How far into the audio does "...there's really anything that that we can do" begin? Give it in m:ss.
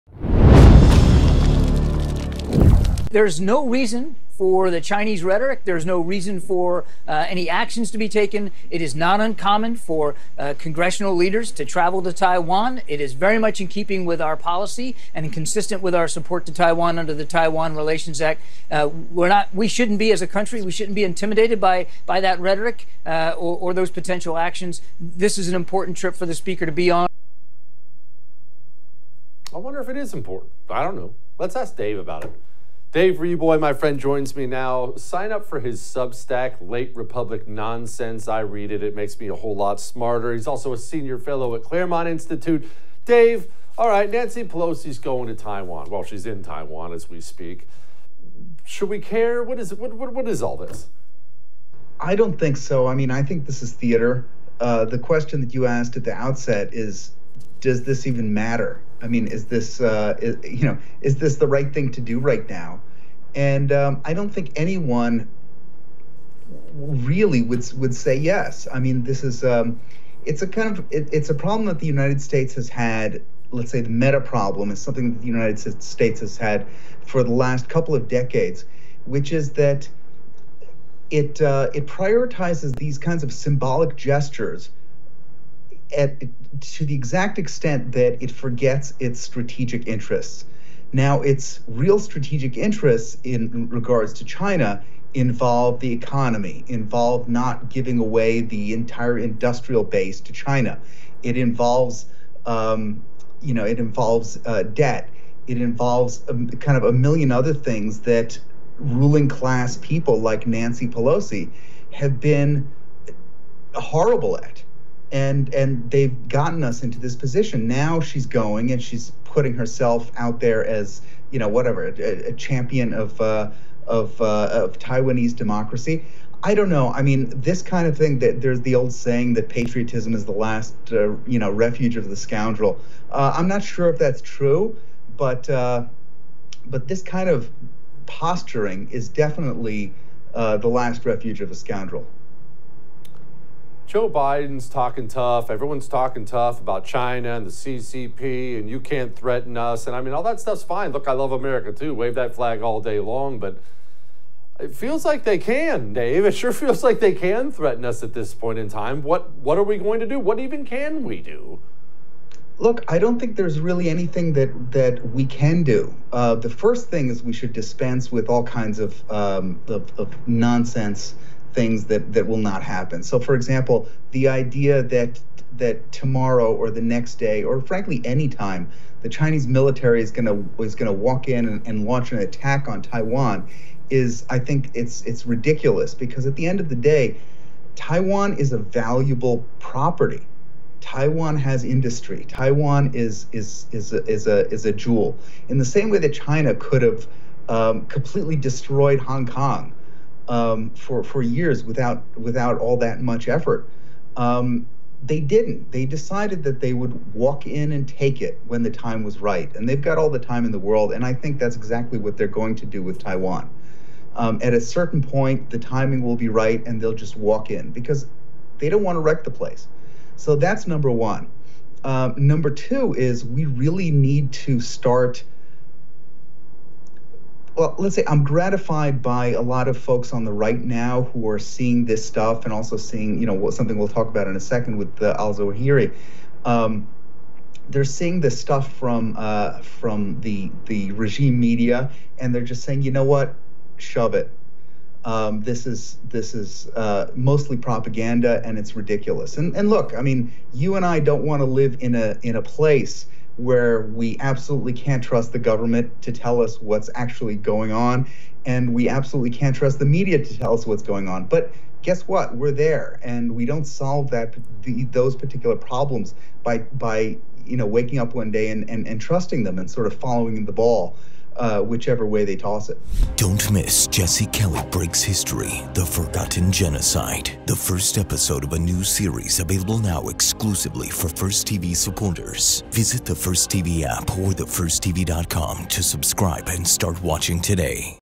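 2:43.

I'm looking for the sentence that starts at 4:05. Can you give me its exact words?
Um, this is this is uh, mostly propaganda, and it's ridiculous.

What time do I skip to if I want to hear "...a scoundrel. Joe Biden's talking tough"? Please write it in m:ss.
2:21.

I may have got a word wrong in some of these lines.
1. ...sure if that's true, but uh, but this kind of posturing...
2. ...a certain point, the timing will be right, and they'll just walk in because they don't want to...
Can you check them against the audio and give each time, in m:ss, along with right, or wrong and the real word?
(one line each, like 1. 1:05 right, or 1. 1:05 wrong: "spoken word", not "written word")
1. 2:13 right
2. 3:34 right.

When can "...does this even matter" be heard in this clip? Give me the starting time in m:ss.
0:57.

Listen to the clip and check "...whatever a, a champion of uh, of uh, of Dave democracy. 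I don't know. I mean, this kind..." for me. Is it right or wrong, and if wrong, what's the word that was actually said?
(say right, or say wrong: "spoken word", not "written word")
wrong: "Taiwanese", not "Dave".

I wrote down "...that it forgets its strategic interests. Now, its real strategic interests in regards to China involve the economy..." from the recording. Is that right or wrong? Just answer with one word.
right.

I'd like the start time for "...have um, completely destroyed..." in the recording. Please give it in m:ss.
3:16.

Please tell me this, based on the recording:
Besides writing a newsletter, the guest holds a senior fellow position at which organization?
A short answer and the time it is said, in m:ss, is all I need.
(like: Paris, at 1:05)
Claremont Institute, at 0:41.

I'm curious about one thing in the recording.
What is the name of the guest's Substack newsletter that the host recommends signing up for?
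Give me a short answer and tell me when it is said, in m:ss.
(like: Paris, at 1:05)
Late Republic Nonsense, at 0:36.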